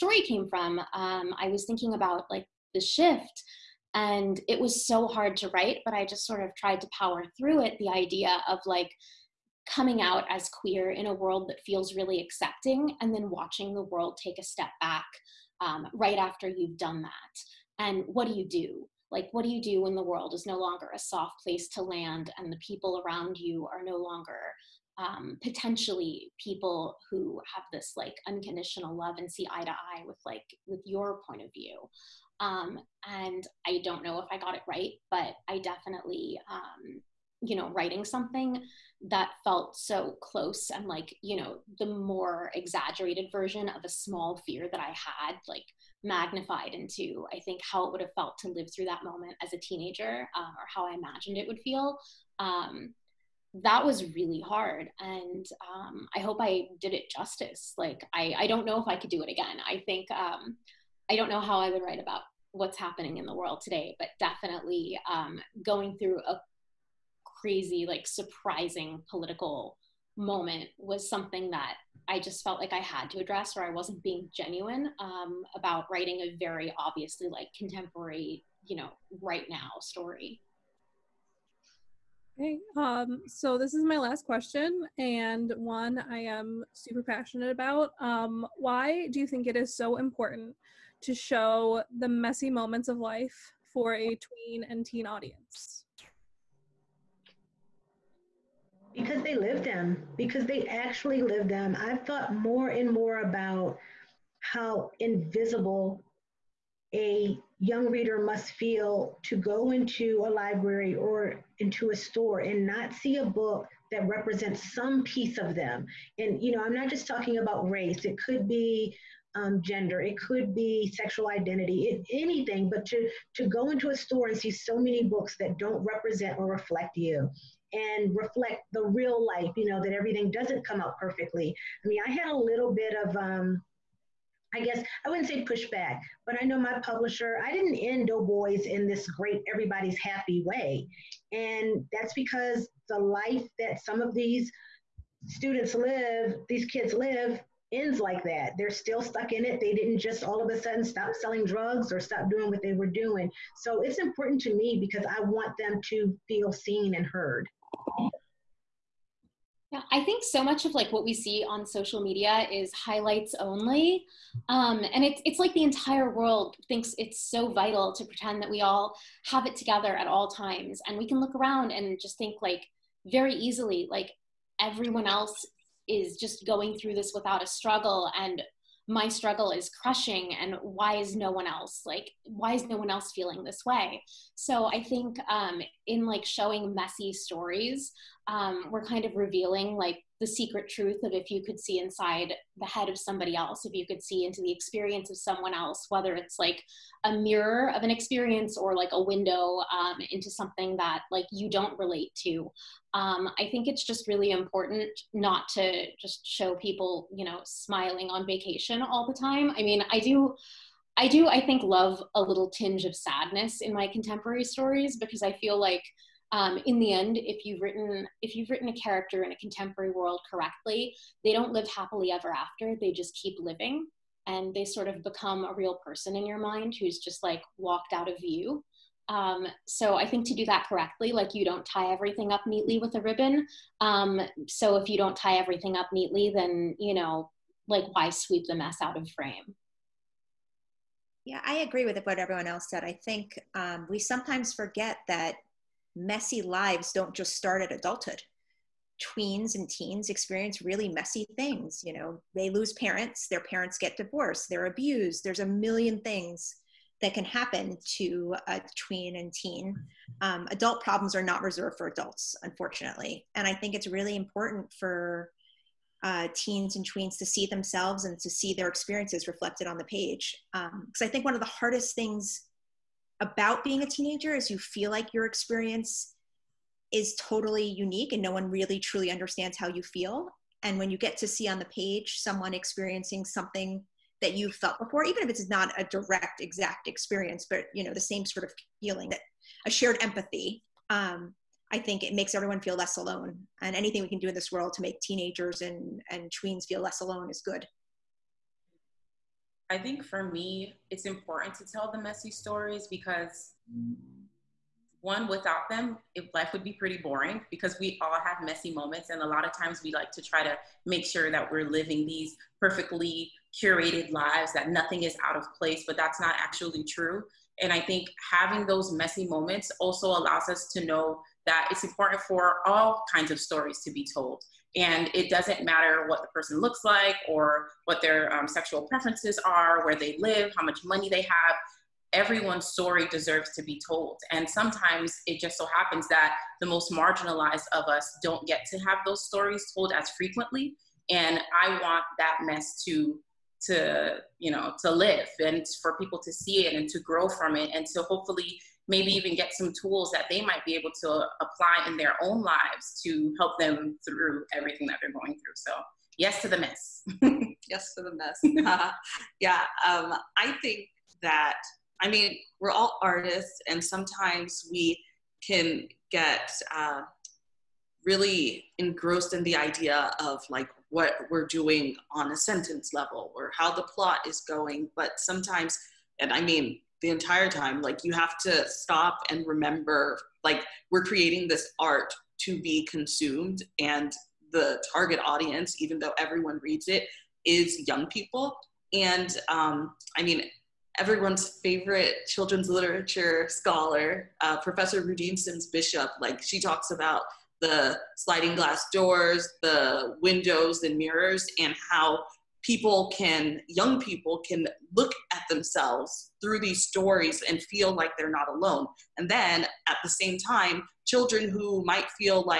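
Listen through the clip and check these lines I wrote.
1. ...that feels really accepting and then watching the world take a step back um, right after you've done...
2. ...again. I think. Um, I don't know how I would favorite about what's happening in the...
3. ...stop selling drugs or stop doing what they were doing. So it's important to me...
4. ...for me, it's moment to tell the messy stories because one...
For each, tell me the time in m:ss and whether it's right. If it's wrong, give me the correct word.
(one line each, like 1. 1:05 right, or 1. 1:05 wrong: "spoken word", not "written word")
1. 0:11 right
2. 0:59 wrong: "write", not "favorite"
3. 2:30 right
4. 5:00 wrong: "important", not "moment".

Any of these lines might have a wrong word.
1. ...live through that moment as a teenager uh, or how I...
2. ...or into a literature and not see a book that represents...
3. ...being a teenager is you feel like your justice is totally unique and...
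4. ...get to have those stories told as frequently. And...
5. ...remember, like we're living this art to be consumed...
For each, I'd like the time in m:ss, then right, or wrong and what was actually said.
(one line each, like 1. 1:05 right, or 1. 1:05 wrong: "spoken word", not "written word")
1. 0:48 right
2. 1:50 wrong: "store", not "literature"
3. 4:33 wrong: "experience", not "justice"
4. 5:38 right
5. 6:19 wrong: "creating", not "living".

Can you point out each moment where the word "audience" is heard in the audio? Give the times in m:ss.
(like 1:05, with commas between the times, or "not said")
1:35, 6:25.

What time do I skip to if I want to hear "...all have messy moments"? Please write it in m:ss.
5:08.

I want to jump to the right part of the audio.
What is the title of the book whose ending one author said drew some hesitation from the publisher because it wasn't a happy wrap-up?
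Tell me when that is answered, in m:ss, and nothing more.
2:18.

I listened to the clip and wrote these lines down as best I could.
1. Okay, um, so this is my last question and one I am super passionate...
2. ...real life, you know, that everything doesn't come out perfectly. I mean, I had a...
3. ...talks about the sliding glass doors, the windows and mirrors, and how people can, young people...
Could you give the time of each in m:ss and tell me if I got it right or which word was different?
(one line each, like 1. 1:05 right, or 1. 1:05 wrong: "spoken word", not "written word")
1. 1:22 right
2. 2:08 right
3. 6:36 right.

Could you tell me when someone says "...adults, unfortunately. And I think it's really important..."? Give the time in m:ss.
4:21.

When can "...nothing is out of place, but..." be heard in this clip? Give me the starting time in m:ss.
5:14.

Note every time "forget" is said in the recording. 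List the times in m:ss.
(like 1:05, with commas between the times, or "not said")
4:04.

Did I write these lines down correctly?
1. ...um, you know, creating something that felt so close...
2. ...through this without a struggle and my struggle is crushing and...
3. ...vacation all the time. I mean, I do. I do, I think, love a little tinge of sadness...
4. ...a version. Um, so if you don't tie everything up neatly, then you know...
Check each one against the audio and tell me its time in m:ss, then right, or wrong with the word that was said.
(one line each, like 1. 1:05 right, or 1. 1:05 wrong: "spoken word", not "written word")
1. 0:36 wrong: "writing", not "creating"
2. 2:56 right
3. 3:28 right
4. 3:52 wrong: "ribbon", not "version".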